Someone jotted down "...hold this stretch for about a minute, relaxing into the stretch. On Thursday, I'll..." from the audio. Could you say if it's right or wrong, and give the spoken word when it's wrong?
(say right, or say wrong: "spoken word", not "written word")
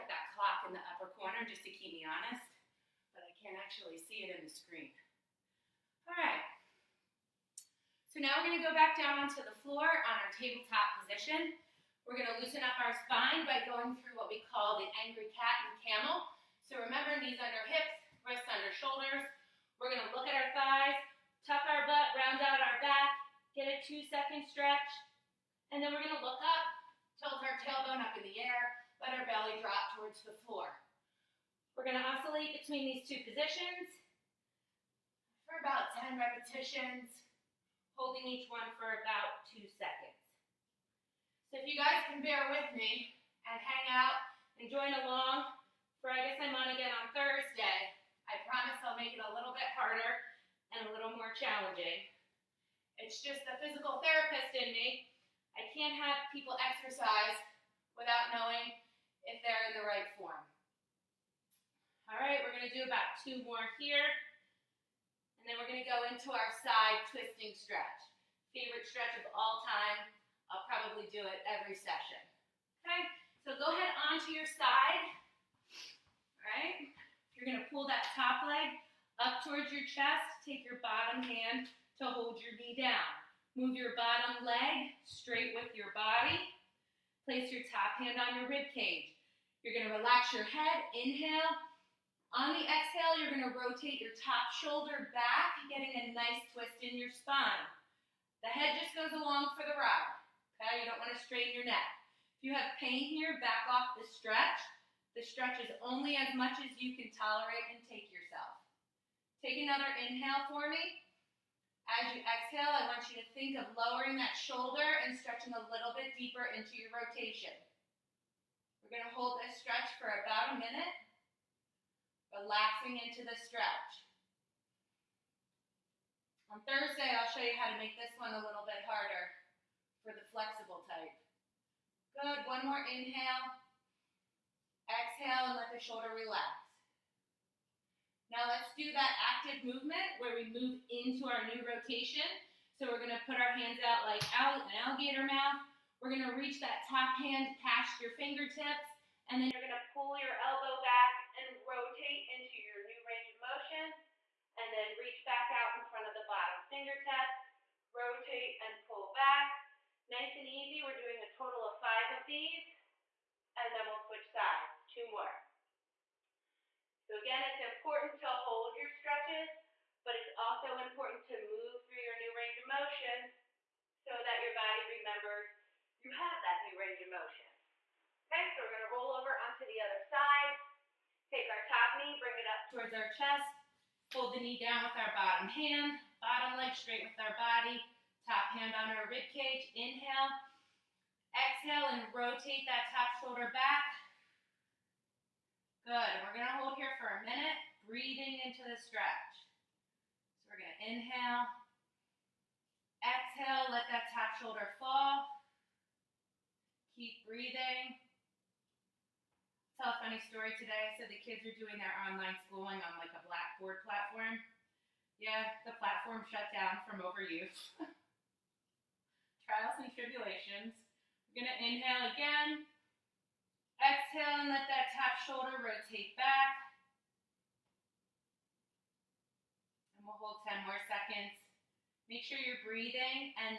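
right.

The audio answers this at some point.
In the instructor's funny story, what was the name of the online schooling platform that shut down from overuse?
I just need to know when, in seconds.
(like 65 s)
213 s.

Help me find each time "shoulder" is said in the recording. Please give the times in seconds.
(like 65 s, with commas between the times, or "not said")
18 s, 94 s, 114 s, 135 s, 193 s, 204 s, 225 s.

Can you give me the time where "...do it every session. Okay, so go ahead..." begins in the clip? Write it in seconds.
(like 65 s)
71 s.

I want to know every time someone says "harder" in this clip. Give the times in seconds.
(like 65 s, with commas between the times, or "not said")
49 s, 128 s.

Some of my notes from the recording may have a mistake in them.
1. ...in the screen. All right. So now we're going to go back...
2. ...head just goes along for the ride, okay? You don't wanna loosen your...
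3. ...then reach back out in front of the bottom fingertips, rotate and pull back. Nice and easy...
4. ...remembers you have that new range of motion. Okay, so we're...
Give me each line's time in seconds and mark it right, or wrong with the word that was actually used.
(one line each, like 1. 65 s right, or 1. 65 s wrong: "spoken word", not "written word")
1. 4 s right
2. 98 s wrong: "straighten", not "loosen"
3. 154 s right
4. 175 s right.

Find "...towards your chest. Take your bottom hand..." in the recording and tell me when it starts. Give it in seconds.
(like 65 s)
79 s.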